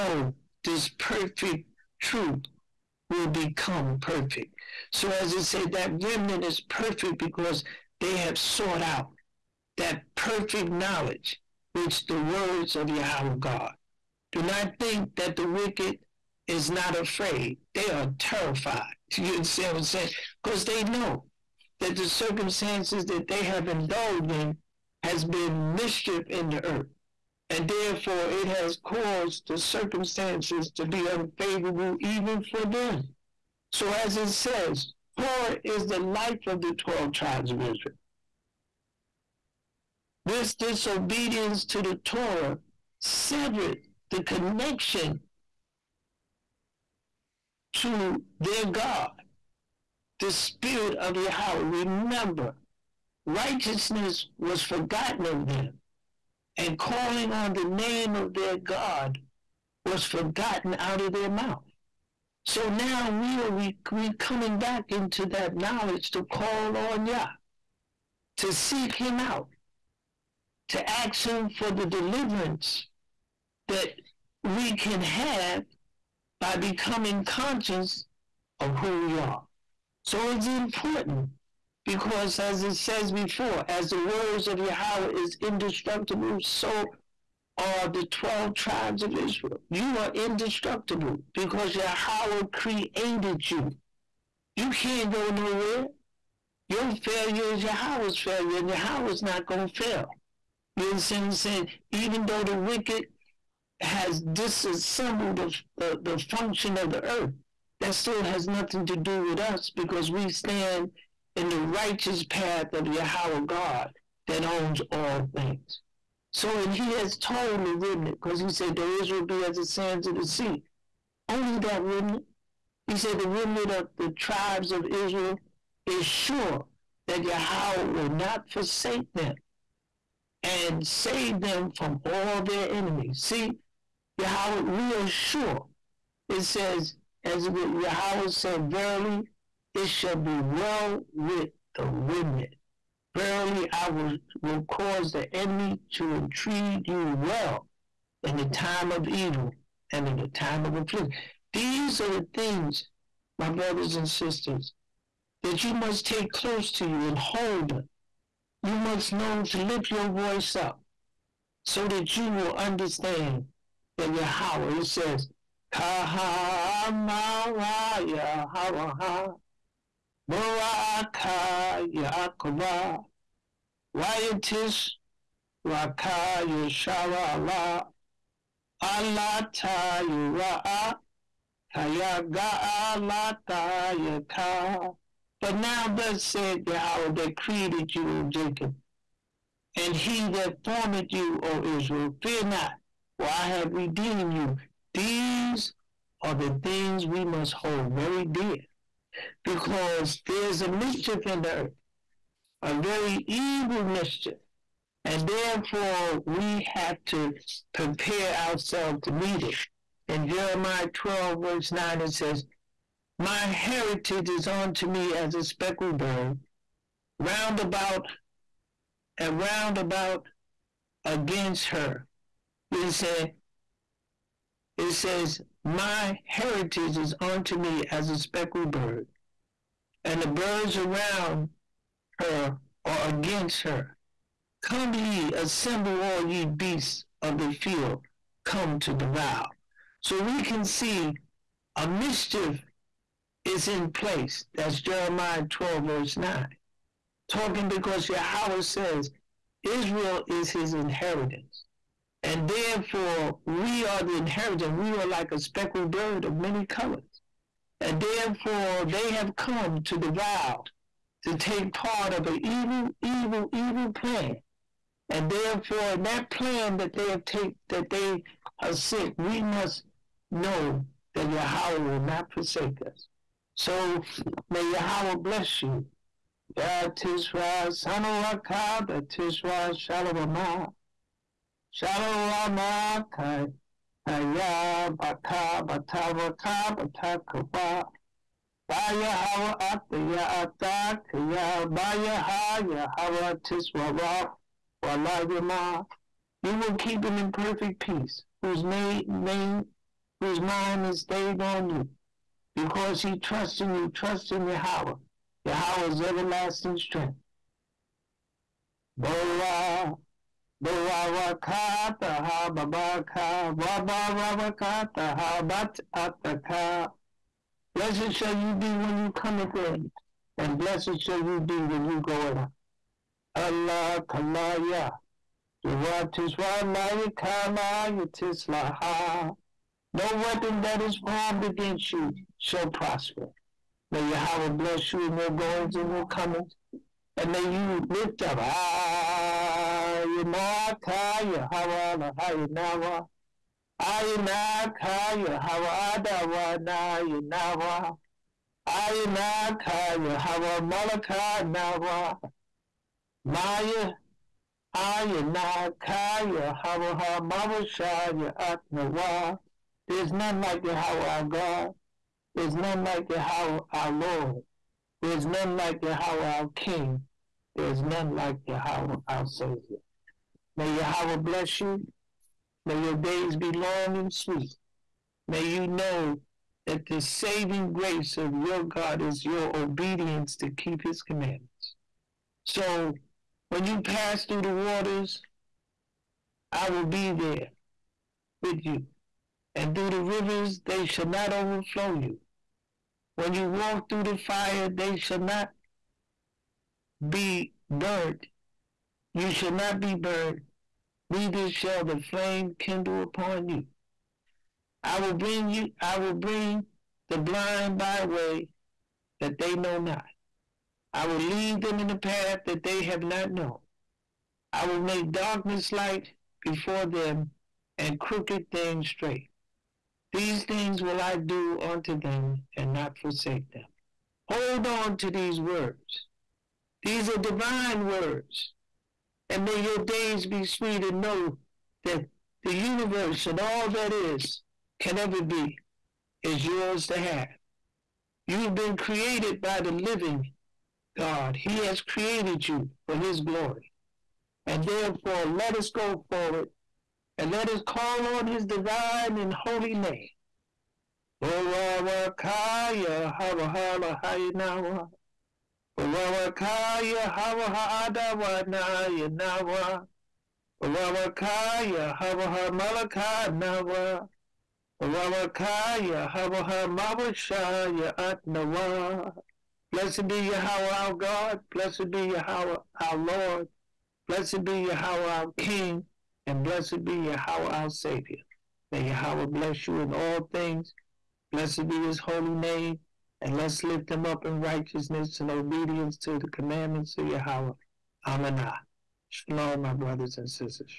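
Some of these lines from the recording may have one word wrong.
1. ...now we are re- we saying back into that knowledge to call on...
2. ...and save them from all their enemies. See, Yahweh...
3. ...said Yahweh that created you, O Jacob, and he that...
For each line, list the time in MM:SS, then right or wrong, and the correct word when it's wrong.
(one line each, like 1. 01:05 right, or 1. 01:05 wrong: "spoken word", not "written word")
1. 01:02 wrong: "coming", not "saying"
2. 02:10 right
3. 03:06 right.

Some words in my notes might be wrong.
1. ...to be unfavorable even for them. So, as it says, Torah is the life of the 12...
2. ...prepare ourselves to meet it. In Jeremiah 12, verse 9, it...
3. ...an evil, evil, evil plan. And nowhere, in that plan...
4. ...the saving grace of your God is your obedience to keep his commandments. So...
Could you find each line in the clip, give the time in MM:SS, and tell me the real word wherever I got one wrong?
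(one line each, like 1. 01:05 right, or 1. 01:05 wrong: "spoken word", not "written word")
1. 00:30 right
2. 03:27 right
3. 04:22 wrong: "therefore", not "nowhere"
4. 06:16 right.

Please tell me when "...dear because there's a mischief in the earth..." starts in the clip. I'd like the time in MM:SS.
03:18.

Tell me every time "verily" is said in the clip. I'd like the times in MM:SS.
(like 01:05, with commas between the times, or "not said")
02:18, 02:23.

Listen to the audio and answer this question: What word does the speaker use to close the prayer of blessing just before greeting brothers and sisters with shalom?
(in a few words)
Amanah.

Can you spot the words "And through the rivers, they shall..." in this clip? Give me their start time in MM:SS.
06:29.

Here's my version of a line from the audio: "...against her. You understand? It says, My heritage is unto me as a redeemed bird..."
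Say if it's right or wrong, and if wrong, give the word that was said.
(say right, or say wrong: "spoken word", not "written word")
wrong: "speckled", not "redeemed".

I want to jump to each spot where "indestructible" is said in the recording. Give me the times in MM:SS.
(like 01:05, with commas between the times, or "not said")
01:25, 01:30.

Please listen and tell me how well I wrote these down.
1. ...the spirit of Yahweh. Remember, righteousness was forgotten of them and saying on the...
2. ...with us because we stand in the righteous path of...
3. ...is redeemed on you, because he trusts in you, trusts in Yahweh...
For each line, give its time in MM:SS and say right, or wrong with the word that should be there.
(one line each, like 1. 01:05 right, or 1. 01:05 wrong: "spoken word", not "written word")
1. 00:50 wrong: "calling", not "saying"
2. 01:49 right
3. 05:00 wrong: "stayed", not "redeemed".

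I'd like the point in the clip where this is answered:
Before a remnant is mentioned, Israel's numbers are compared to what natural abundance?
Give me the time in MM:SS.
01:59.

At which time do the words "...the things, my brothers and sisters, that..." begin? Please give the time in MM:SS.
02:32.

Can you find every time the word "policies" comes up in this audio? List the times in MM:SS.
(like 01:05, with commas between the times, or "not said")
not said.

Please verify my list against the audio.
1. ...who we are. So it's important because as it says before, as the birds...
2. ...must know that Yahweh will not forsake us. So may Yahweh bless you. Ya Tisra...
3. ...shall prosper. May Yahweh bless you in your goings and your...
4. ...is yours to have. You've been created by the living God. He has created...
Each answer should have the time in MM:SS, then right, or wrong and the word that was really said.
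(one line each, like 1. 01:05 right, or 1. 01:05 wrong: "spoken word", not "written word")
1. 01:18 wrong: "words", not "birds"
2. 04:29 right
3. 05:32 right
4. 07:16 right.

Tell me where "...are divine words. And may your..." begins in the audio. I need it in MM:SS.
07:07.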